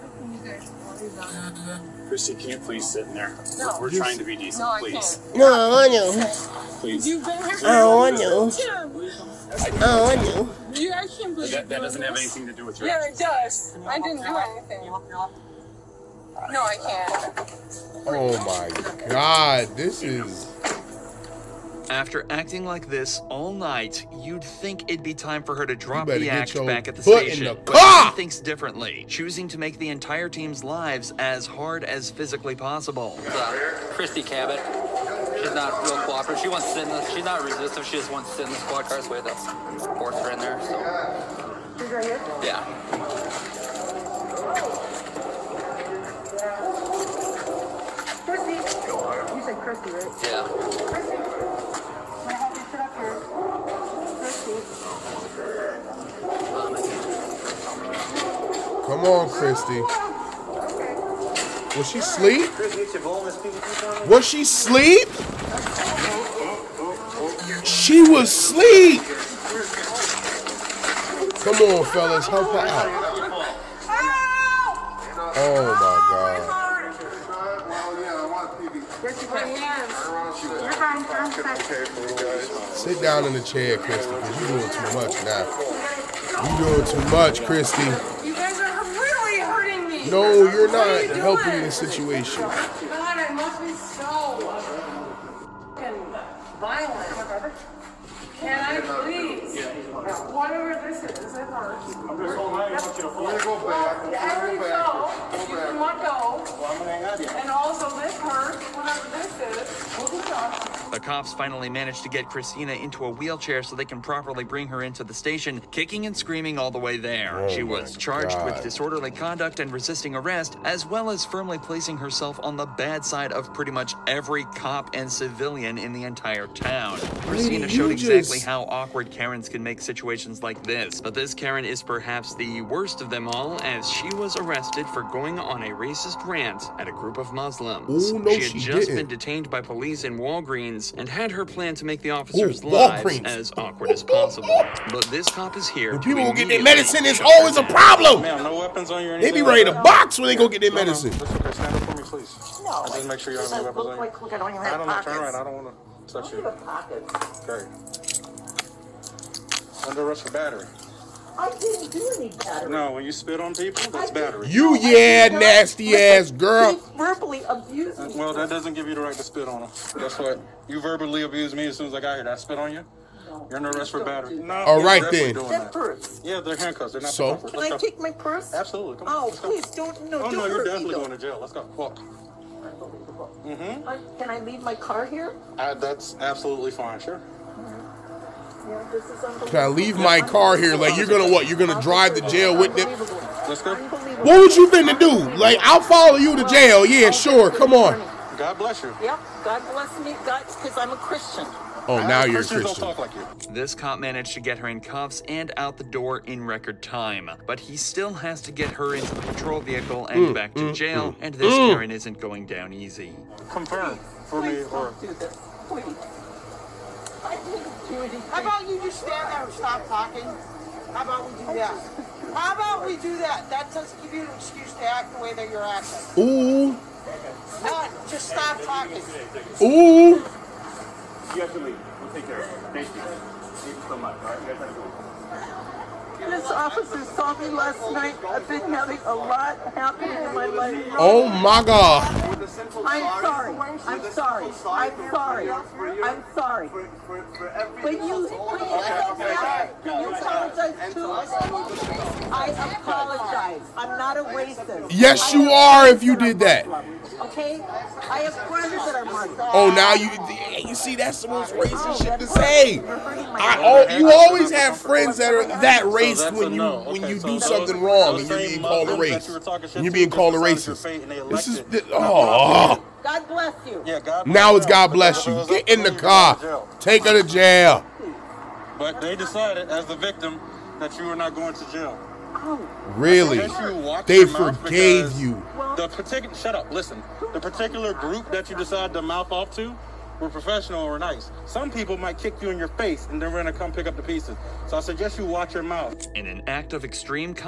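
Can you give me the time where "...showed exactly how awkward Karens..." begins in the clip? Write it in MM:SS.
02:07.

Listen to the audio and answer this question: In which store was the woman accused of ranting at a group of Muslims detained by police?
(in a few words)
Walgreens.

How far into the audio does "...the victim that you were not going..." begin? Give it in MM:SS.
04:39.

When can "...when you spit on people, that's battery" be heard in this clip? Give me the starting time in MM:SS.
02:42.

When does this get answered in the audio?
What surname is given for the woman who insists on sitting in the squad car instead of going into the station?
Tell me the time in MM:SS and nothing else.
00:33.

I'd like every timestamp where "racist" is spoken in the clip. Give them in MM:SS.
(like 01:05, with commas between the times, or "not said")
02:15, 04:14, 04:21, 04:30.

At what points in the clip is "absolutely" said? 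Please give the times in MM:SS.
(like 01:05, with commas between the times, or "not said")
02:58, 03:06.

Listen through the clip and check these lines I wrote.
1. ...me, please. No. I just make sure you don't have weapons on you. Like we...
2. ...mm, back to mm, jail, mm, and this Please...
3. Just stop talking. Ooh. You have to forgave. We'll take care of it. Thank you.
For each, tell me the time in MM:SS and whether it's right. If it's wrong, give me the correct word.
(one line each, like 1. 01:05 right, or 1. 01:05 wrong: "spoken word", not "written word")
1. 02:31 right
2. 03:30 wrong: "Karen", not "Please"
3. 03:48 wrong: "leave", not "forgave".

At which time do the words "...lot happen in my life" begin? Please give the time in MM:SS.
03:59.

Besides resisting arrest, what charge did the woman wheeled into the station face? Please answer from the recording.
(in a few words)
Disorderly conduct.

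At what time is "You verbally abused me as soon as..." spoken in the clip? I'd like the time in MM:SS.
02:50.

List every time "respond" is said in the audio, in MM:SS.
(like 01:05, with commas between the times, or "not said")
not said.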